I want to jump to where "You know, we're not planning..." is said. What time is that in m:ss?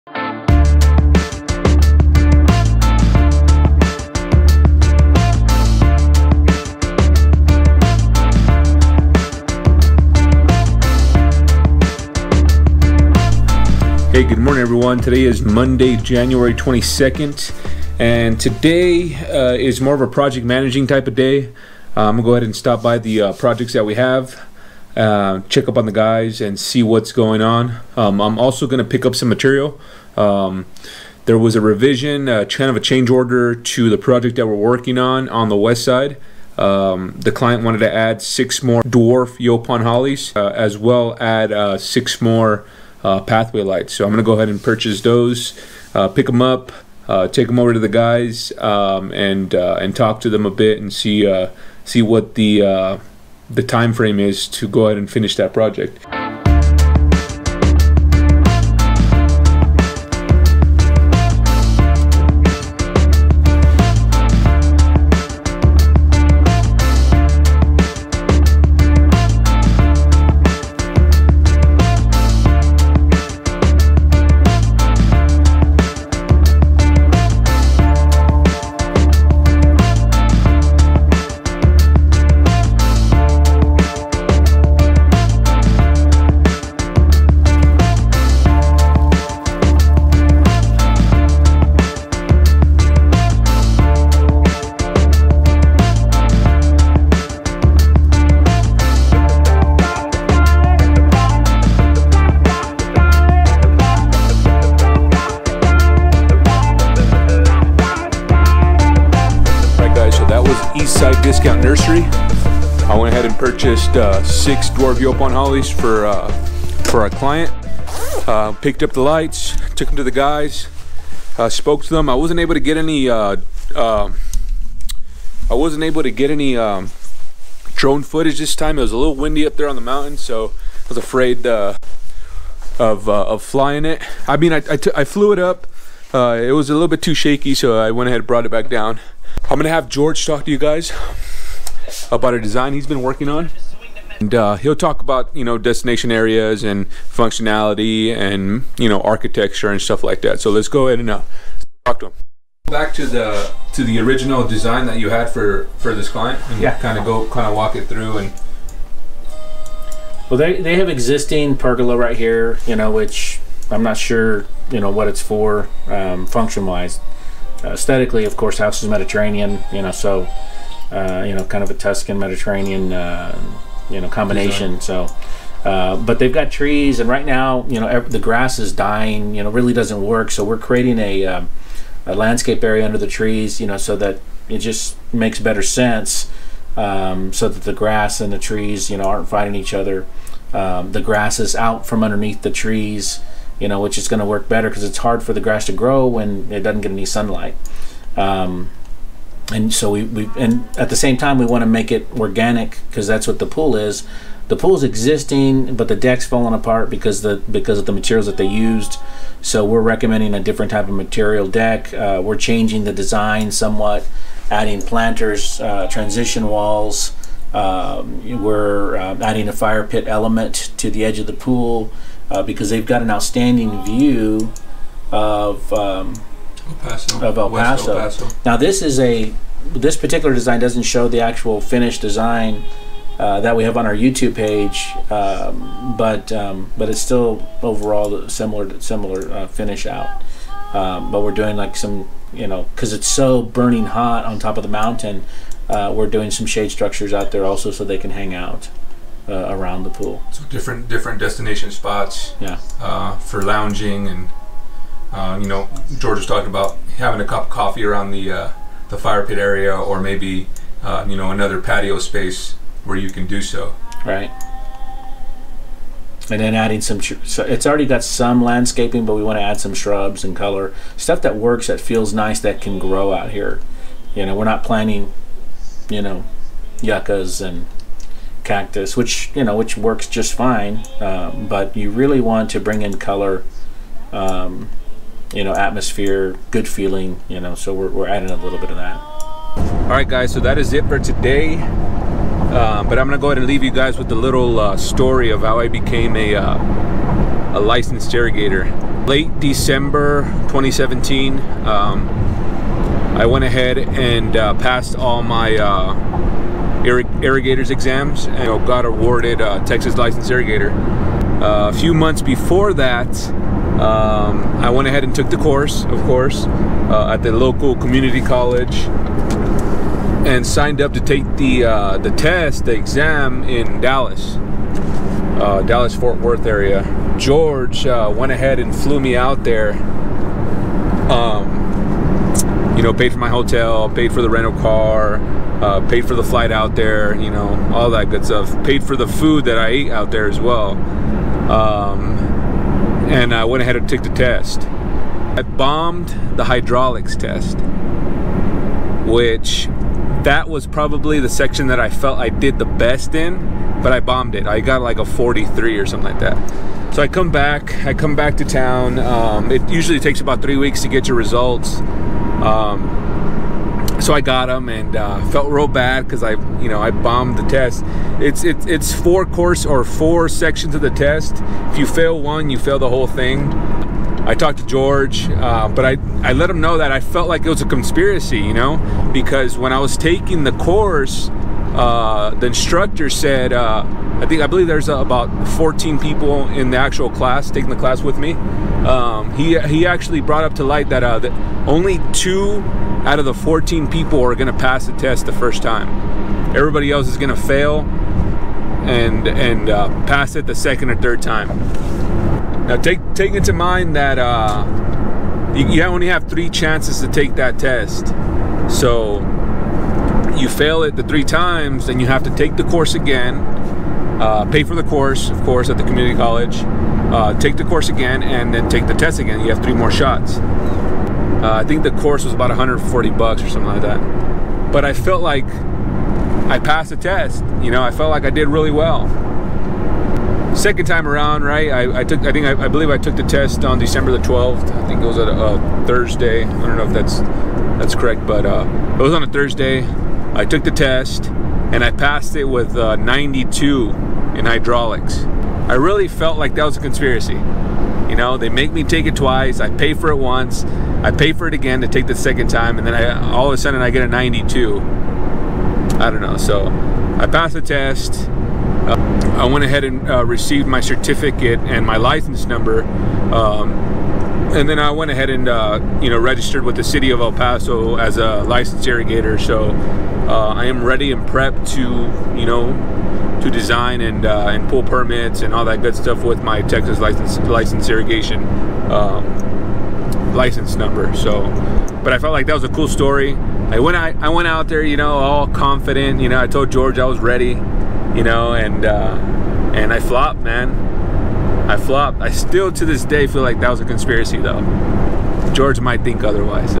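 4:34.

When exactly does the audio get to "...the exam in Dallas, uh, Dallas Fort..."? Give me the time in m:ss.
5:22.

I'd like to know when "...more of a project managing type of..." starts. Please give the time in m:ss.
0:19.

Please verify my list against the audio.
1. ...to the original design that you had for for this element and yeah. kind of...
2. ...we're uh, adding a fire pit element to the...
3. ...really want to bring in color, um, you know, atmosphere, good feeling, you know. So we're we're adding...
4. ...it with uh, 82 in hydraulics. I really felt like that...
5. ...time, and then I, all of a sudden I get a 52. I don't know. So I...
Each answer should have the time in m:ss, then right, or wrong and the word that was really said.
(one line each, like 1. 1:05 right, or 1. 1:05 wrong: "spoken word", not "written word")
1. 2:33 wrong: "client", not "element"
2. 3:38 right
3. 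4:41 right
4. 7:22 wrong: "92", not "82"
5. 7:32 wrong: "92", not "52".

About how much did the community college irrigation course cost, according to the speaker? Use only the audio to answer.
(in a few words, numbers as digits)
$140.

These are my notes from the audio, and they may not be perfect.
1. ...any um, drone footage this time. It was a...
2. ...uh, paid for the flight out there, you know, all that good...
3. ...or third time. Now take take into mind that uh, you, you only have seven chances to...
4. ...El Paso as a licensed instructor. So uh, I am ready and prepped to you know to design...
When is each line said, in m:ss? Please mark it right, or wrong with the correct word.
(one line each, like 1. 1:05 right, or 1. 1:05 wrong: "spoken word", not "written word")
1. 2:06 right
2. 5:35 right
3. 6:40 wrong: "three", not "seven"
4. 7:47 wrong: "irrigator", not "instructor".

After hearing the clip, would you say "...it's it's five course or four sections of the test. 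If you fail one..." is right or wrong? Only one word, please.
wrong.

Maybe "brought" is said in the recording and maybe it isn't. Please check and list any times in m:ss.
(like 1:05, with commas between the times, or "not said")
2:18, 6:30.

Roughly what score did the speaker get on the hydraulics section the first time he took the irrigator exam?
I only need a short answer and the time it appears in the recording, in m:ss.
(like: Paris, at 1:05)
43, at 5:55.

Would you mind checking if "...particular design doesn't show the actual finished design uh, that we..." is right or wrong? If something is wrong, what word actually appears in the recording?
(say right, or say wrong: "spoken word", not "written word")
right.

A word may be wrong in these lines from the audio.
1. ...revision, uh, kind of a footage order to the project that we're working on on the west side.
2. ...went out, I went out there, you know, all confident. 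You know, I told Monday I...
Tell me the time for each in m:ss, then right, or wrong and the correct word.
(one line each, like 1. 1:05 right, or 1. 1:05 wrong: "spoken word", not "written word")
1. 0:31 wrong: "change", not "footage"
2. 8:03 wrong: "George", not "Monday".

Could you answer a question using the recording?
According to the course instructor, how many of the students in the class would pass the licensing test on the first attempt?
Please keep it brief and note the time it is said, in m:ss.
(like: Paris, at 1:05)
2, at 6:32.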